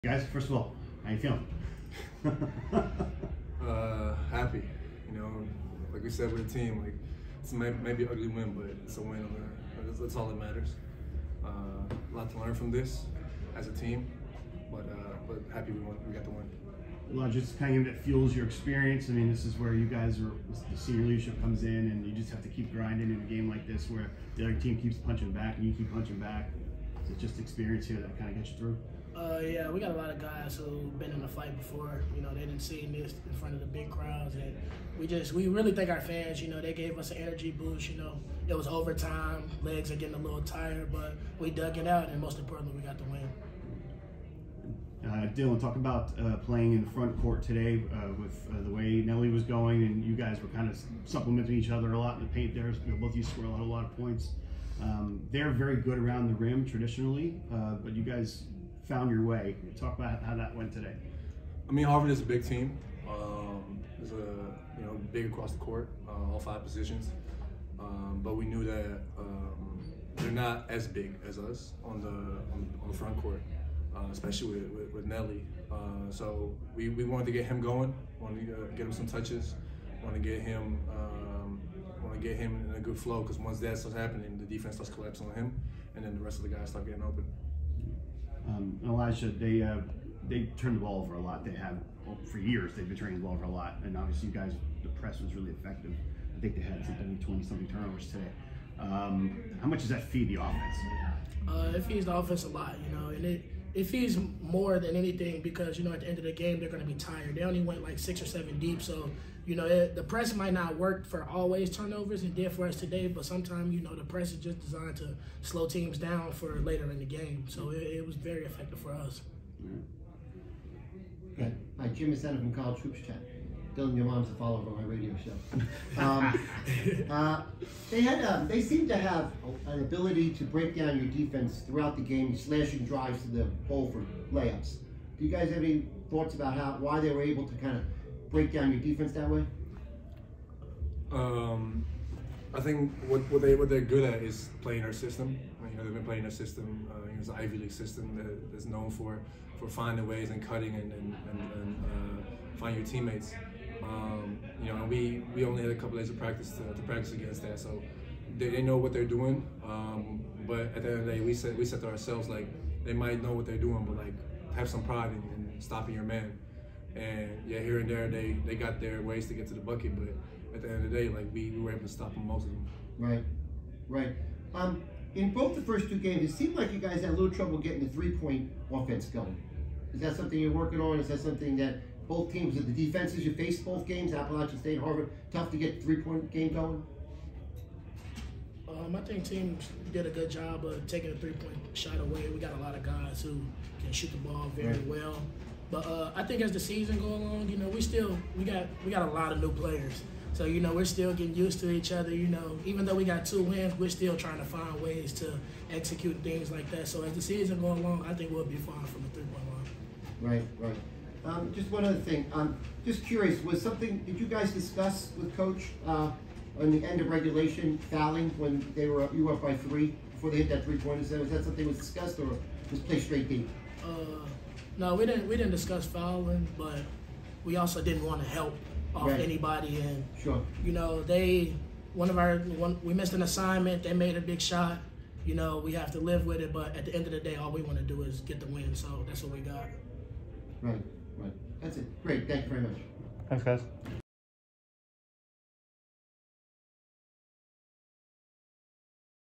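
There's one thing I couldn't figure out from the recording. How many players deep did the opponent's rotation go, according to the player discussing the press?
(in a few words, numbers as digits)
6 or 7.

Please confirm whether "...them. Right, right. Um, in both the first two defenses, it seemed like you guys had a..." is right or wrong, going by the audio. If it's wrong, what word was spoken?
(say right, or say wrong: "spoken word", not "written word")
wrong: "games", not "defenses".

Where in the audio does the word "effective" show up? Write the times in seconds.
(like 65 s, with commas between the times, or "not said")
95 s, 118 s.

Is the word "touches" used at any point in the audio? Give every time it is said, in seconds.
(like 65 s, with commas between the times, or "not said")
79 s.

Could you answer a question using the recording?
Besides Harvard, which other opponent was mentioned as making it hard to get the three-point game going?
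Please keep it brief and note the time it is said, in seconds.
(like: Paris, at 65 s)
Appalachian State, at 184 s.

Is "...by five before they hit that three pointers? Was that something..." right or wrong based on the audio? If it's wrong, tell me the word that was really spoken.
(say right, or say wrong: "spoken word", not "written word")
wrong: "three", not "five".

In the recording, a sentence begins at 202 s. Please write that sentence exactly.
You know, even though we got two wins, we're still trying to find ways to execute things like that.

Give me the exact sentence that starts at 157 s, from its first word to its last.
So they, they know what they're doing.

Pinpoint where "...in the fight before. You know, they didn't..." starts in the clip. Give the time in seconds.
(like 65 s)
31 s.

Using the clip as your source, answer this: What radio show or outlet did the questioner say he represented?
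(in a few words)
College Hoops Chat.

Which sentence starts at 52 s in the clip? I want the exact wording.
You know, both of you scored a lot of points.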